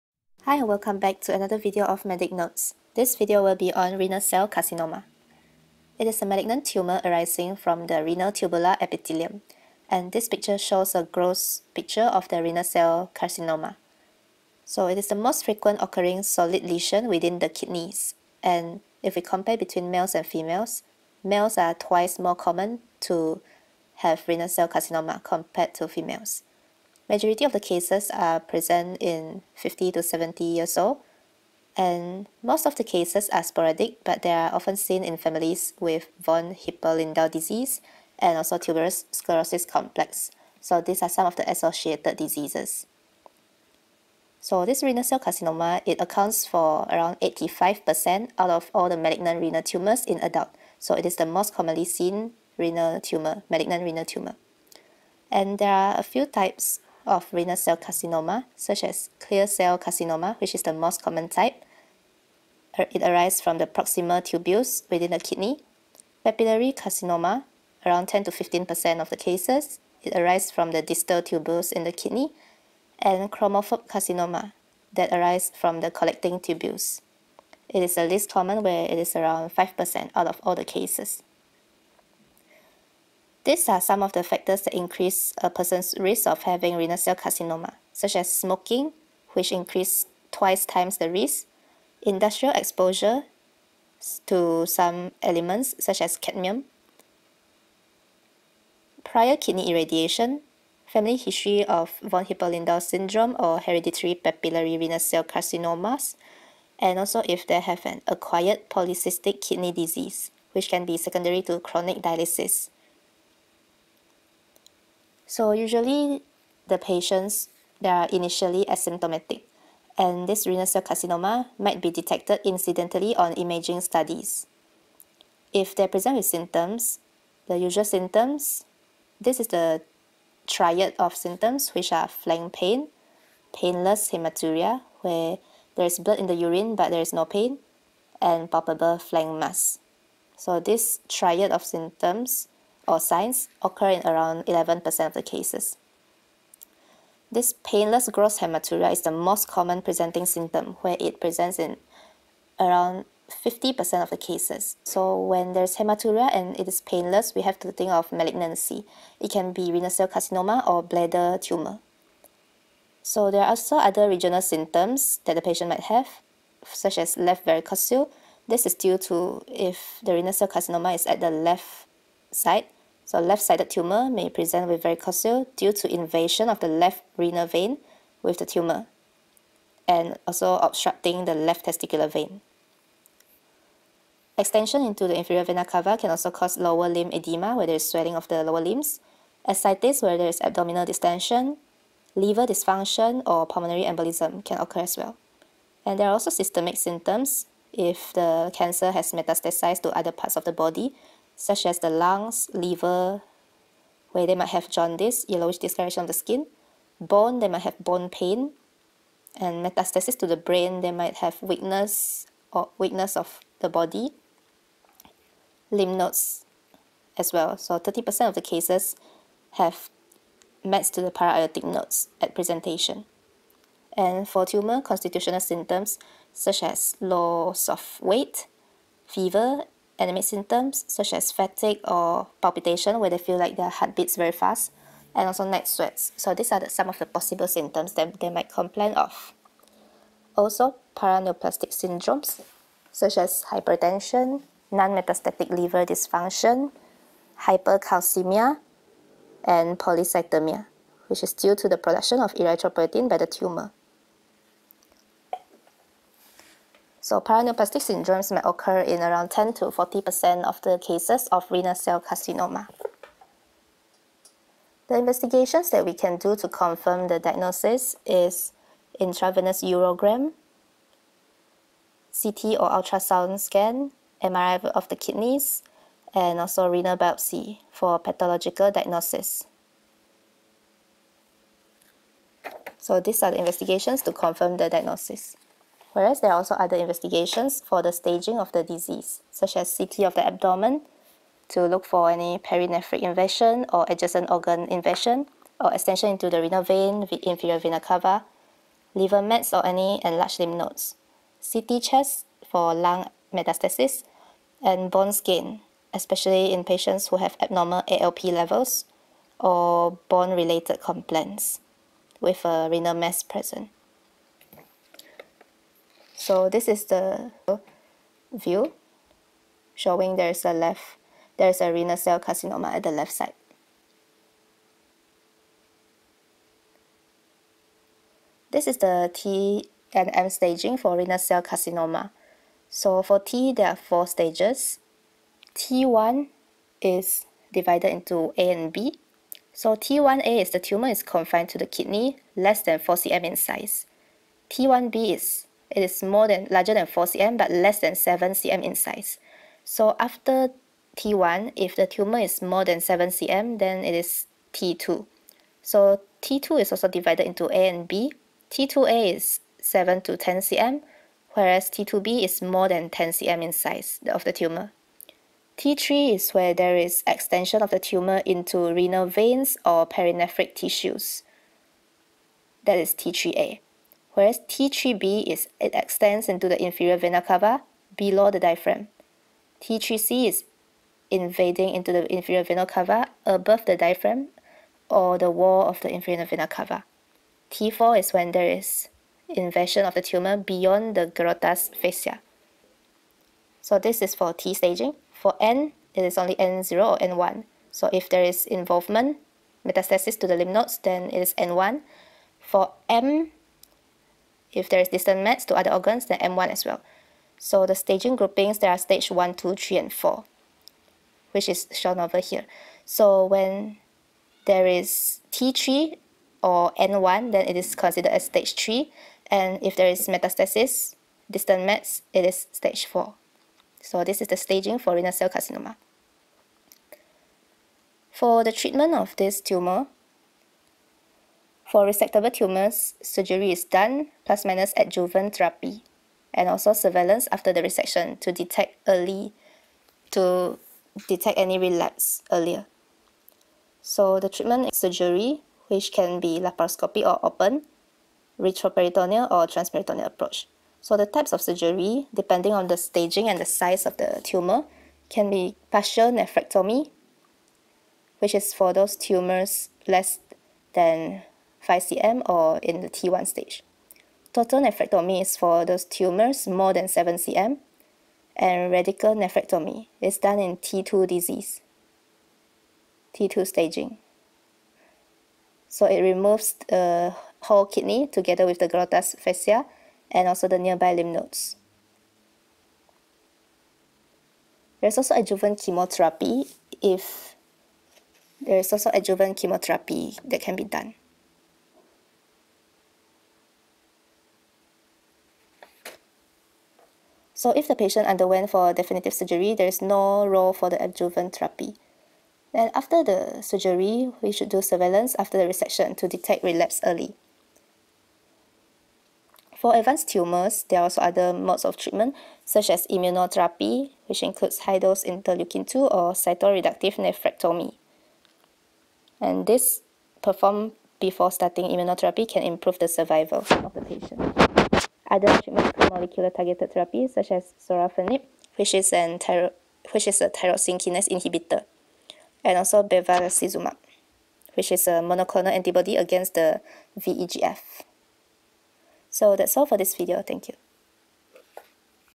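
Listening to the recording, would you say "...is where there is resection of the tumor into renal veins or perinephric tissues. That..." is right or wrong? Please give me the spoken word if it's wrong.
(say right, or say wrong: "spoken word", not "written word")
wrong: "extension", not "resection".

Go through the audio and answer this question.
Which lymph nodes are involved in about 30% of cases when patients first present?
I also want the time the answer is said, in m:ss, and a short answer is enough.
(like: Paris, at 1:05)
Para-aortic nodes, at 3:41.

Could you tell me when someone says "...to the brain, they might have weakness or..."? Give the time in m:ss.
3:30.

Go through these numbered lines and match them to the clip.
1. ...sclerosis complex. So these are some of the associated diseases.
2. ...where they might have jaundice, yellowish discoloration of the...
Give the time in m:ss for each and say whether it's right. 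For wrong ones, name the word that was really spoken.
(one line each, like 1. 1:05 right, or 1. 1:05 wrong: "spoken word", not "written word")
1. 0:39 right
2. 3:24 right.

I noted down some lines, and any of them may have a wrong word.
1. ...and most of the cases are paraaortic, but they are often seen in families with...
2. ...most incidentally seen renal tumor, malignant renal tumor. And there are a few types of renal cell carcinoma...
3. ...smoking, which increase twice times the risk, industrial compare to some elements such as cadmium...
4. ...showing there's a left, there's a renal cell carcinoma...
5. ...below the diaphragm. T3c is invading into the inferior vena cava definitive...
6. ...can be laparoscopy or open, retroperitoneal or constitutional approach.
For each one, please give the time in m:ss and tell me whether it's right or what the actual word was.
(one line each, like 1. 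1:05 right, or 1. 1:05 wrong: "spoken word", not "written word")
1. 0:31 wrong: "sporadic", not "paraaortic"
2. 0:51 wrong: "commonly", not "incidentally"
3. 1:28 wrong: "exposure", not "compare"
4. 5:19 right
5. 6:17 wrong: "above", not "definitive"
6. 7:25 wrong: "transperitoneal", not "constitutional".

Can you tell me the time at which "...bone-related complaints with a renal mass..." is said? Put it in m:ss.
5:10.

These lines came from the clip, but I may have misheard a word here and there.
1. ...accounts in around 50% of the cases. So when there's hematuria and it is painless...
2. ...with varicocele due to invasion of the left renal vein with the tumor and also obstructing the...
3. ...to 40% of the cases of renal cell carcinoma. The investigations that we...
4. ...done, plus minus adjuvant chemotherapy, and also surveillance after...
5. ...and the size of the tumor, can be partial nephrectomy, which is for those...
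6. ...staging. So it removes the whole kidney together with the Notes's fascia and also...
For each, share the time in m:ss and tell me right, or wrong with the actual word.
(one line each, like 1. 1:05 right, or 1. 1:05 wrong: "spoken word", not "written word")
1. 2:31 wrong: "presents", not "accounts"
2. 2:54 right
3. 4:19 right
4. 7:13 wrong: "therapy", not "chemotherapy"
5. 7:33 right
6. 7:53 wrong: "Gerota", not "Notes".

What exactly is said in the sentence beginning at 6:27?
T4 is when there is invasion of the tumor beyond the Gerota's fascia.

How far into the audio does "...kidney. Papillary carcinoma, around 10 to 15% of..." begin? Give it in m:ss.
1:05.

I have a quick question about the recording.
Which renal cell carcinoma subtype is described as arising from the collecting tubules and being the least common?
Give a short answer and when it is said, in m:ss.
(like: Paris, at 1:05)
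Chromophobe carcinoma, at 1:13.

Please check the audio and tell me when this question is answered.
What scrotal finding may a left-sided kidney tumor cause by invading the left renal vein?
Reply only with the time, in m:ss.
2:47.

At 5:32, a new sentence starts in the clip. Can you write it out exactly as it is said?
So for T, there are four stages.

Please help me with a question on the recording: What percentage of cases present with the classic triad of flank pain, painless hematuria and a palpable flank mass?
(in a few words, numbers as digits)
11%.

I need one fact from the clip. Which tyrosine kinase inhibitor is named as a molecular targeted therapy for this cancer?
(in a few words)
Sorafenib.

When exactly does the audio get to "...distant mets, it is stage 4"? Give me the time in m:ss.
7:01.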